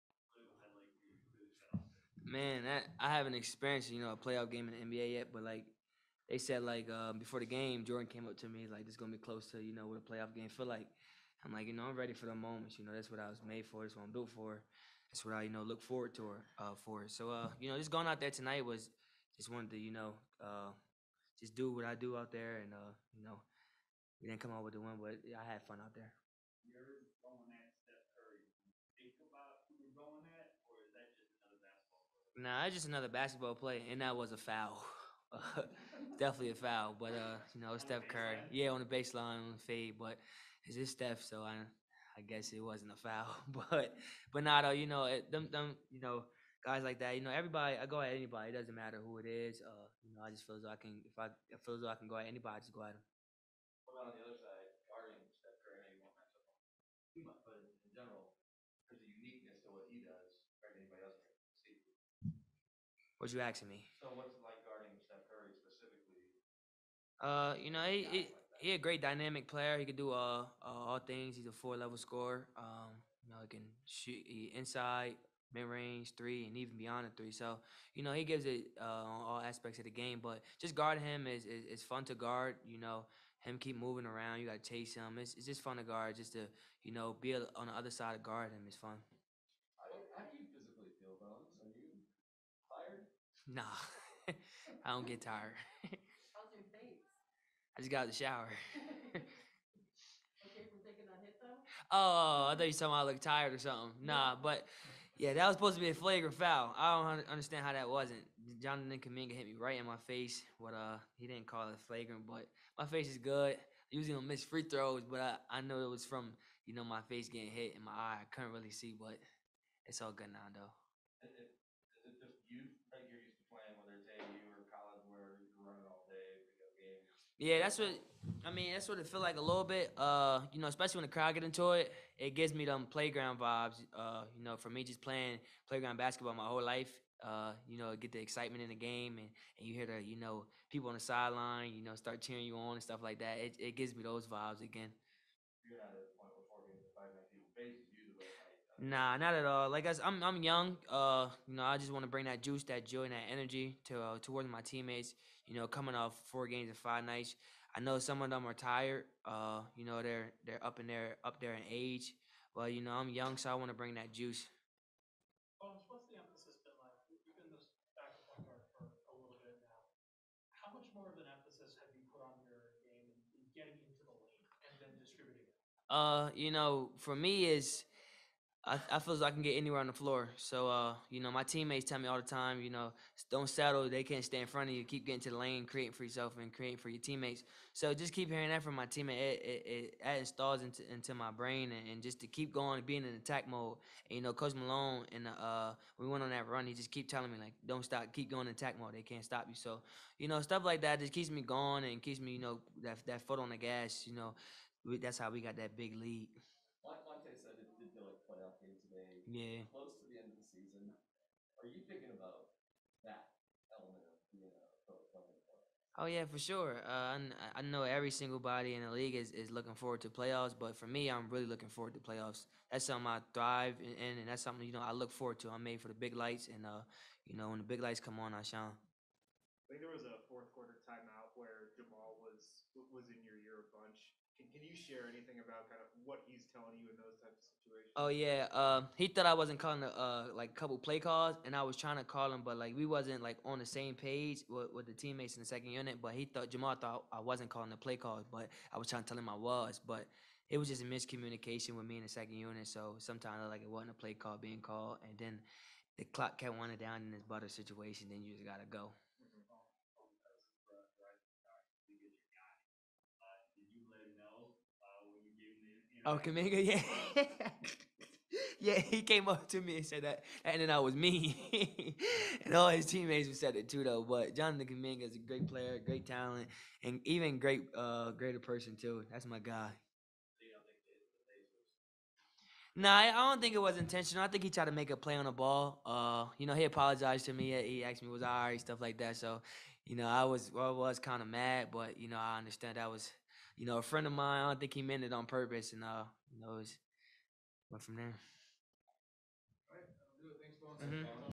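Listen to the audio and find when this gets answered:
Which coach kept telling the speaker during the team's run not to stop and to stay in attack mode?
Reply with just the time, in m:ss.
3:14.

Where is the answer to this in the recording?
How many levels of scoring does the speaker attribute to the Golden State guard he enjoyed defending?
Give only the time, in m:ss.
1:11.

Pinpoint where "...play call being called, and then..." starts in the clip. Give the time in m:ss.
4:13.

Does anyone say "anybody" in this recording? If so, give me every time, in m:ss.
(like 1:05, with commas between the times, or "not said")
0:48, 0:52.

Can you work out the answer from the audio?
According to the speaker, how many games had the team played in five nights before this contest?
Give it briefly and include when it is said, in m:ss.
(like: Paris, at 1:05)
4, at 2:36.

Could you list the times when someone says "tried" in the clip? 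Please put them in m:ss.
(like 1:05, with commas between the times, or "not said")
4:44.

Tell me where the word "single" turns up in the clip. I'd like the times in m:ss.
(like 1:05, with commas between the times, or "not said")
3:38.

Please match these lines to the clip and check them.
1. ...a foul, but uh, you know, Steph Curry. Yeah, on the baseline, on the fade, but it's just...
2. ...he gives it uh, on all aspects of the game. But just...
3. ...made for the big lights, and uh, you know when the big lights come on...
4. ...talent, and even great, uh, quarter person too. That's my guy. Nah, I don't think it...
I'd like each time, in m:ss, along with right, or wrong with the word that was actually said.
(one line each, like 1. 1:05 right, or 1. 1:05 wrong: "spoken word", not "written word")
1. 0:36 right
2. 1:18 right
3. 3:45 right
4. 4:36 wrong: "greater", not "quarter".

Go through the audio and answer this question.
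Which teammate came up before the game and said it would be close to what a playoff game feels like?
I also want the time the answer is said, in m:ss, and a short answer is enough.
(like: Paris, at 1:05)
Jordan, at 0:07.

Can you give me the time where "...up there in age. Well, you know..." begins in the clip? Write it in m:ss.
2:41.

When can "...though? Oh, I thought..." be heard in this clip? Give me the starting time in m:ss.
1:41.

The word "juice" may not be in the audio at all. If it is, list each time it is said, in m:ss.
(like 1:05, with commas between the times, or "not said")
2:32, 2:44.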